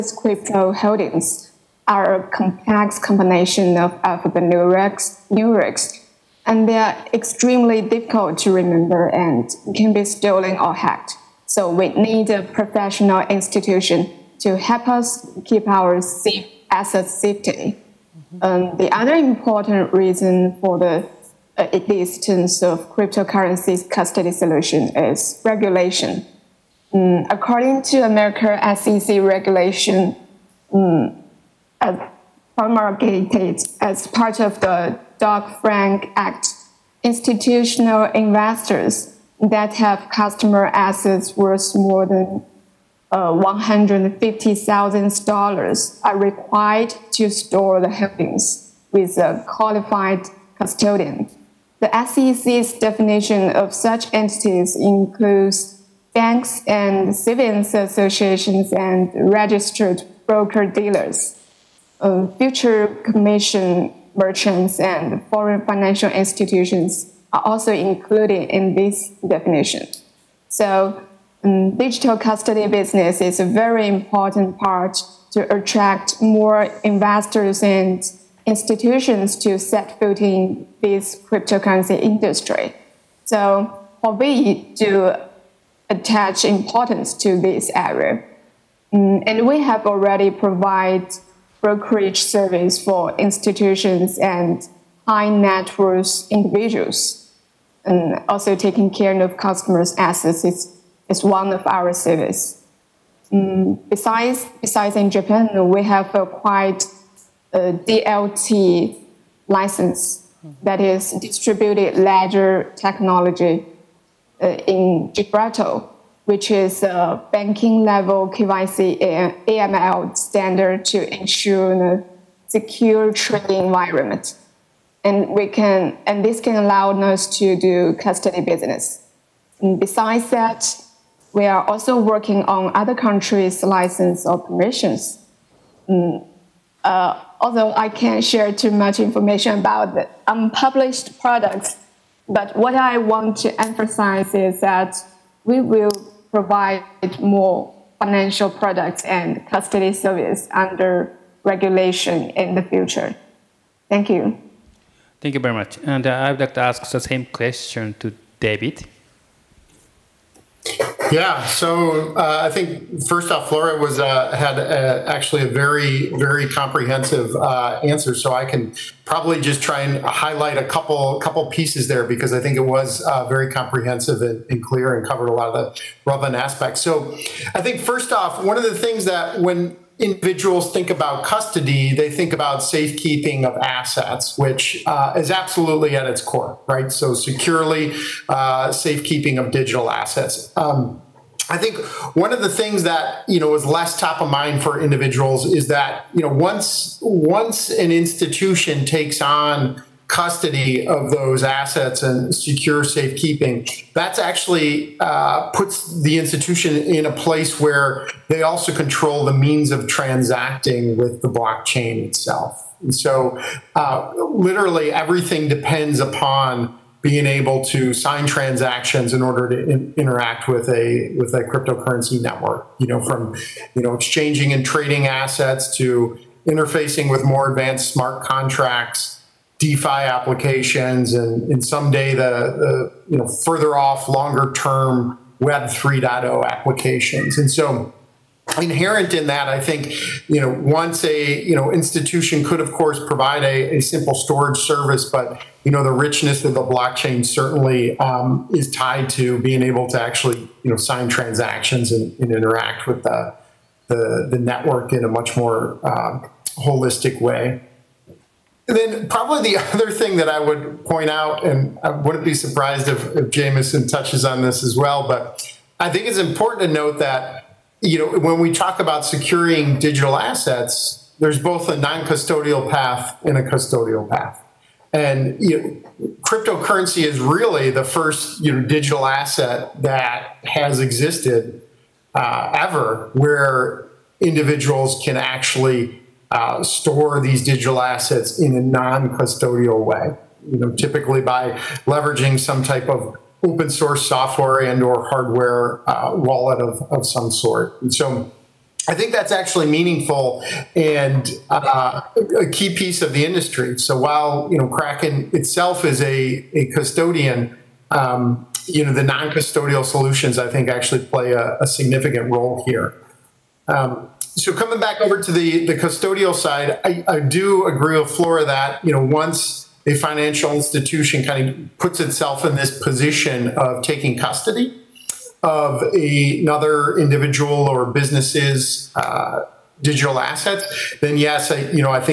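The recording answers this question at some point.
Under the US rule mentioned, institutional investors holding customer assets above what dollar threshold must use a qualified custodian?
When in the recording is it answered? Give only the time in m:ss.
0:43.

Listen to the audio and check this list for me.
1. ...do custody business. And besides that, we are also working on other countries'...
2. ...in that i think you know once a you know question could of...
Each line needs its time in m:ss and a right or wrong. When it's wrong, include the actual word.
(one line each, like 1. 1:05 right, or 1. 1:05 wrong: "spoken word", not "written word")
1. 2:07 right
2. 3:59 wrong: "institution", not "question".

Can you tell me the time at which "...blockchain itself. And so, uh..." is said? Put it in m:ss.
3:31.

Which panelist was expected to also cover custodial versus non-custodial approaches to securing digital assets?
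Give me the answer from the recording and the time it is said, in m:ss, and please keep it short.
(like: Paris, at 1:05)
Jameson, at 4:23.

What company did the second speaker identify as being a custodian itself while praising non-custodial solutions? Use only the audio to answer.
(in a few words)
Kraken.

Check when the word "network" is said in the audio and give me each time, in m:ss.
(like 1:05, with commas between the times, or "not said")
3:42, 4:14.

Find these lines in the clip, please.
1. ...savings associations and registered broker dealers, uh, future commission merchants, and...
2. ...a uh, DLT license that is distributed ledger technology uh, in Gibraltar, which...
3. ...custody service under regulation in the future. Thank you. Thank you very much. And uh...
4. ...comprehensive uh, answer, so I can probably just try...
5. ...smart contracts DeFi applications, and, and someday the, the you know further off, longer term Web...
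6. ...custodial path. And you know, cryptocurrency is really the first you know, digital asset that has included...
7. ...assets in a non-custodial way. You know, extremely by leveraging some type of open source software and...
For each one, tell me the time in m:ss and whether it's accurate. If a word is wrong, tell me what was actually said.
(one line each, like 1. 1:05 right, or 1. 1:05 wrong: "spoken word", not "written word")
1. 0:57 right
2. 1:47 right
3. 2:29 right
4. 2:46 right
5. 3:47 right
6. 4:33 wrong: "existed", not "included"
7. 4:47 wrong: "typically", not "extremely".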